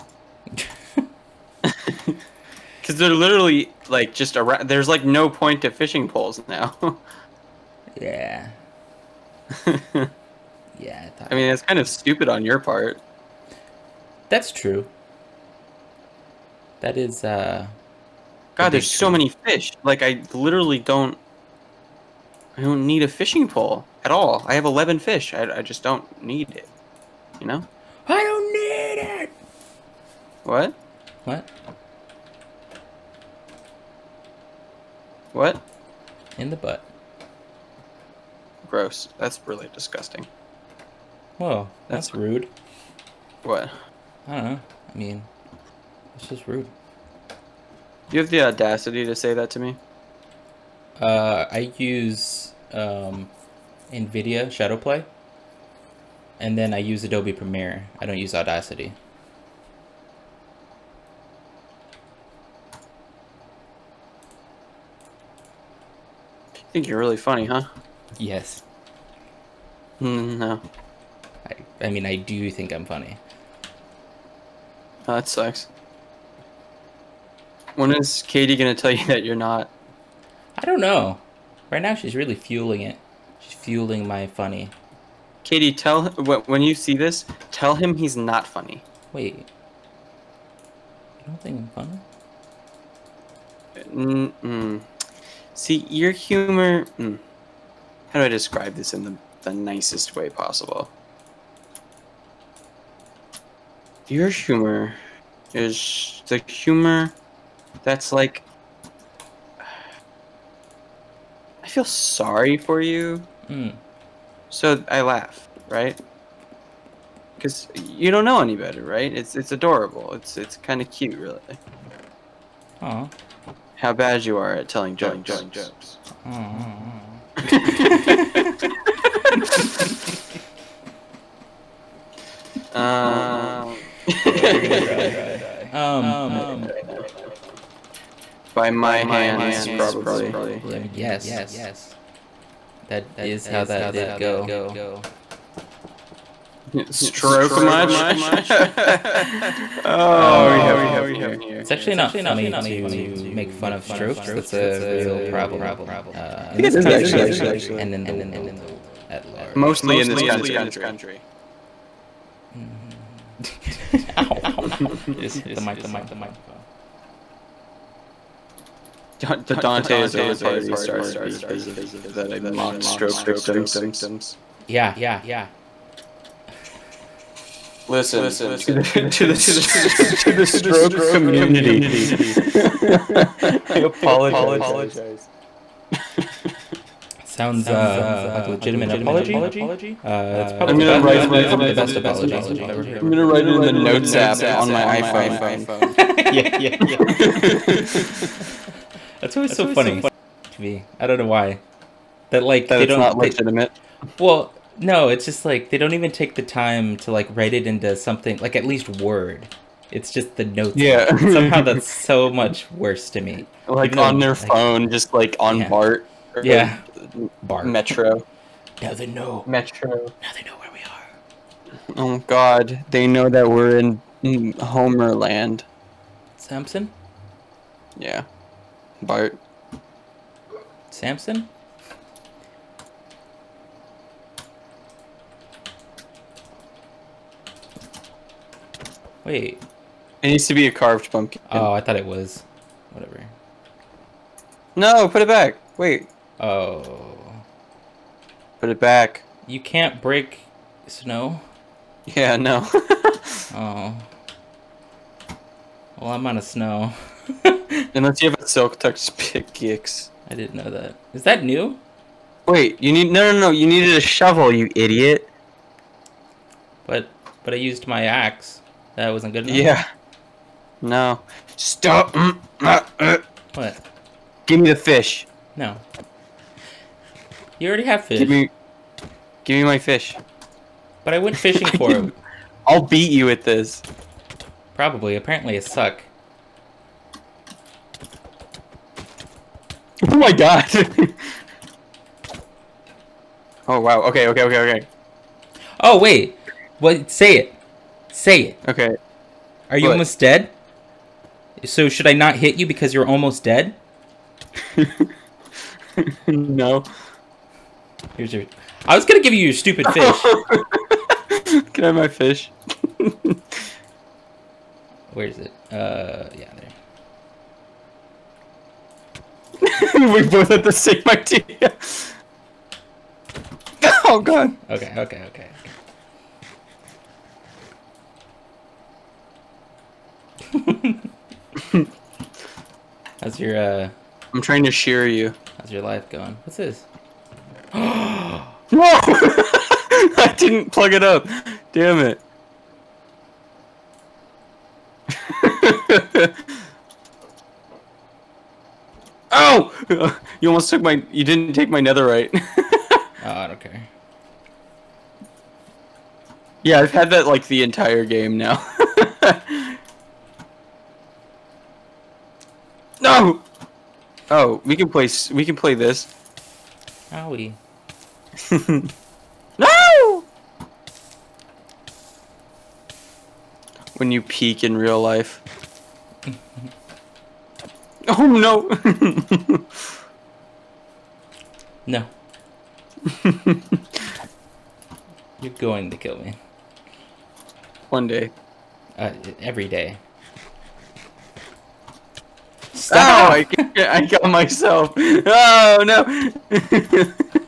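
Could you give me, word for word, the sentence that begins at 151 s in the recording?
It's actually not funny to make fun of strokes.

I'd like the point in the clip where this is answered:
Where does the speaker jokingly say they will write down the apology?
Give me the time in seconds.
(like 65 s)
193 s.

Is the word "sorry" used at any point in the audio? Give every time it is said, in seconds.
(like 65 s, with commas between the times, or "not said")
111 s.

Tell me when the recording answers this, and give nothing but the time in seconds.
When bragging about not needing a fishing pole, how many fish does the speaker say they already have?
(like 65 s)
24 s.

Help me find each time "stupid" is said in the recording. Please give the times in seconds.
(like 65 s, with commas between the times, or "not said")
11 s, 309 s.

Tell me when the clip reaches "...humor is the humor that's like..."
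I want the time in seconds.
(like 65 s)
104 s.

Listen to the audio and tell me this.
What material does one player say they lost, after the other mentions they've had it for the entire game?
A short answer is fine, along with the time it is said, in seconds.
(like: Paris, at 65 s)
netherite, at 351 s.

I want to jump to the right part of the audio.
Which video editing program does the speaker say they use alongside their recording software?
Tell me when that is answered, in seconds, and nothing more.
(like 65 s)
57 s.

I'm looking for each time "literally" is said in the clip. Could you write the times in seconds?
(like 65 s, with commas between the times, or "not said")
3 s, 20 s.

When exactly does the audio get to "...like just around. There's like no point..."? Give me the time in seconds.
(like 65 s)
3 s.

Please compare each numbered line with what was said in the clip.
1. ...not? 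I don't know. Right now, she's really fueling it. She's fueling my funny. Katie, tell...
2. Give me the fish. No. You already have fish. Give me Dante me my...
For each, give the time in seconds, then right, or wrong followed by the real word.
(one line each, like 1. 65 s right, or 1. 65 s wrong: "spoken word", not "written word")
1. 79 s right
2. 274 s wrong: "Give", not "Dante".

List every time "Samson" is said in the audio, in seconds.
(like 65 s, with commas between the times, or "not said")
226 s, 230 s.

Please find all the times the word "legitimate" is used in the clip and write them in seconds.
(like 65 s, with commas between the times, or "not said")
188 s, 203 s.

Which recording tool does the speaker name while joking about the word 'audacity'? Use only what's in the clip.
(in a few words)
NVIDIA Shadowplay.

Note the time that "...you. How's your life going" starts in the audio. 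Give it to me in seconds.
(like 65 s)
335 s.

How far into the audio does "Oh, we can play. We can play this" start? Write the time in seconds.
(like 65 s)
364 s.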